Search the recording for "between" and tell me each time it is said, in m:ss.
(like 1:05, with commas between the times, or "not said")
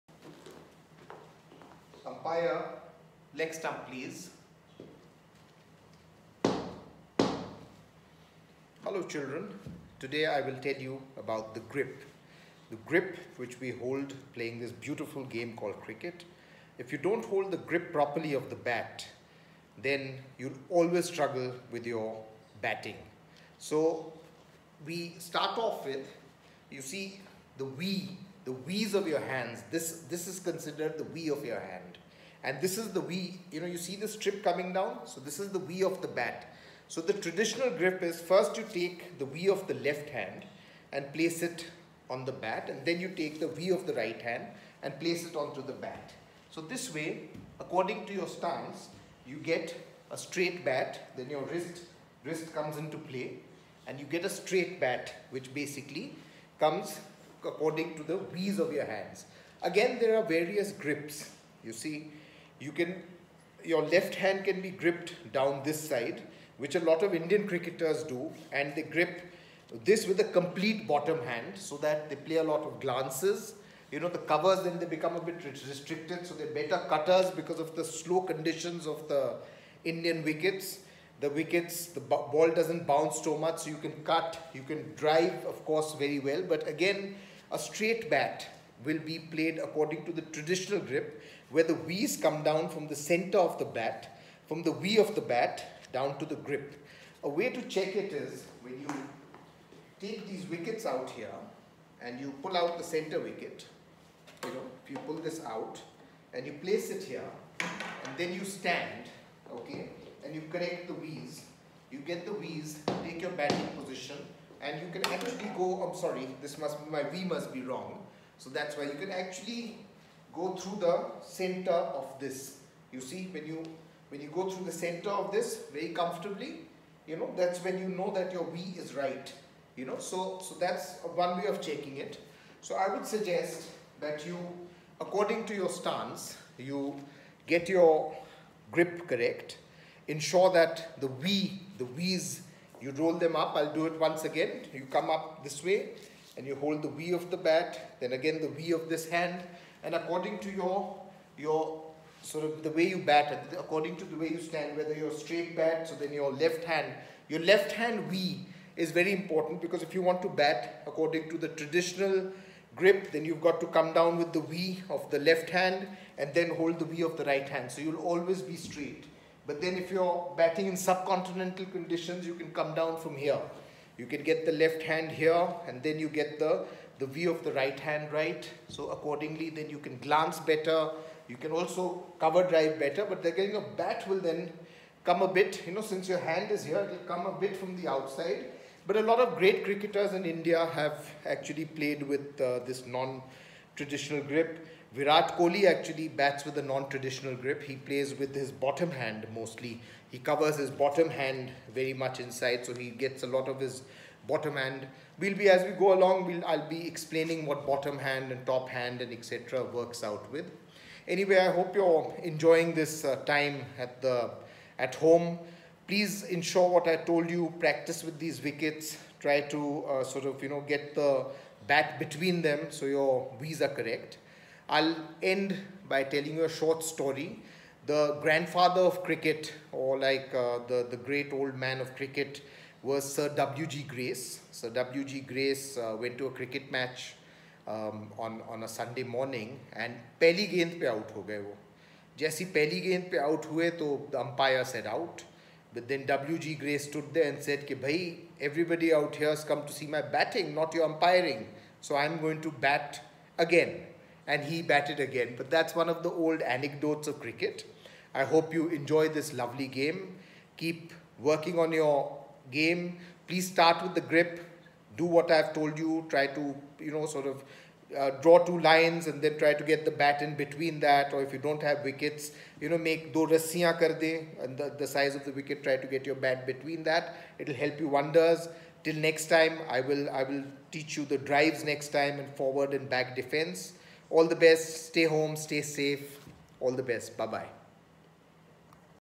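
3:41, 4:30, 4:36.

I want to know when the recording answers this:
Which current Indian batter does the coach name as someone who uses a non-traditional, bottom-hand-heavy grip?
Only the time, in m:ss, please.
3:14.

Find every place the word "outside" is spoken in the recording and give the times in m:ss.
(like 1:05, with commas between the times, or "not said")
3:07.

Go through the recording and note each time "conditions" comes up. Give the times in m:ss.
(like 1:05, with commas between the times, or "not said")
1:18, 2:51.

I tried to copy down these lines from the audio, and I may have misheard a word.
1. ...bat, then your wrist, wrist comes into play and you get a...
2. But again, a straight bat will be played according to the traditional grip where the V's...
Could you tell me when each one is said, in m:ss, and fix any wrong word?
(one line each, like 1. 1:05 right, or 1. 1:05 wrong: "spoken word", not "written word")
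1. 0:50 right
2. 1:26 right.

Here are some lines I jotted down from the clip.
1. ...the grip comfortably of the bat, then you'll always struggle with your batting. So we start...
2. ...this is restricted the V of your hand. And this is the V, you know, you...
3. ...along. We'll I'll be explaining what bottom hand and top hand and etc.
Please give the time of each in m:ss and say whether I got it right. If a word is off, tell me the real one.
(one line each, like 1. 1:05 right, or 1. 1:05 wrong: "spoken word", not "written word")
1. 0:17 wrong: "properly", not "comfortably"
2. 0:30 wrong: "considered", not "restricted"
3. 3:25 right.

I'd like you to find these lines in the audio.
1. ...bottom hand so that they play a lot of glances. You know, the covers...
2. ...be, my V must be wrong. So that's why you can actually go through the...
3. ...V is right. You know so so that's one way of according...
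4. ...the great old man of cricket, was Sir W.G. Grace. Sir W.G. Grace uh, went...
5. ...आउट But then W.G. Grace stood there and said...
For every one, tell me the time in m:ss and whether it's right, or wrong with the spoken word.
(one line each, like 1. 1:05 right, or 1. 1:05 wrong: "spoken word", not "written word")
1. 1:10 right
2. 1:56 right
3. 2:08 wrong: "checking", not "according"
4. 3:50 right
5. 4:04 right.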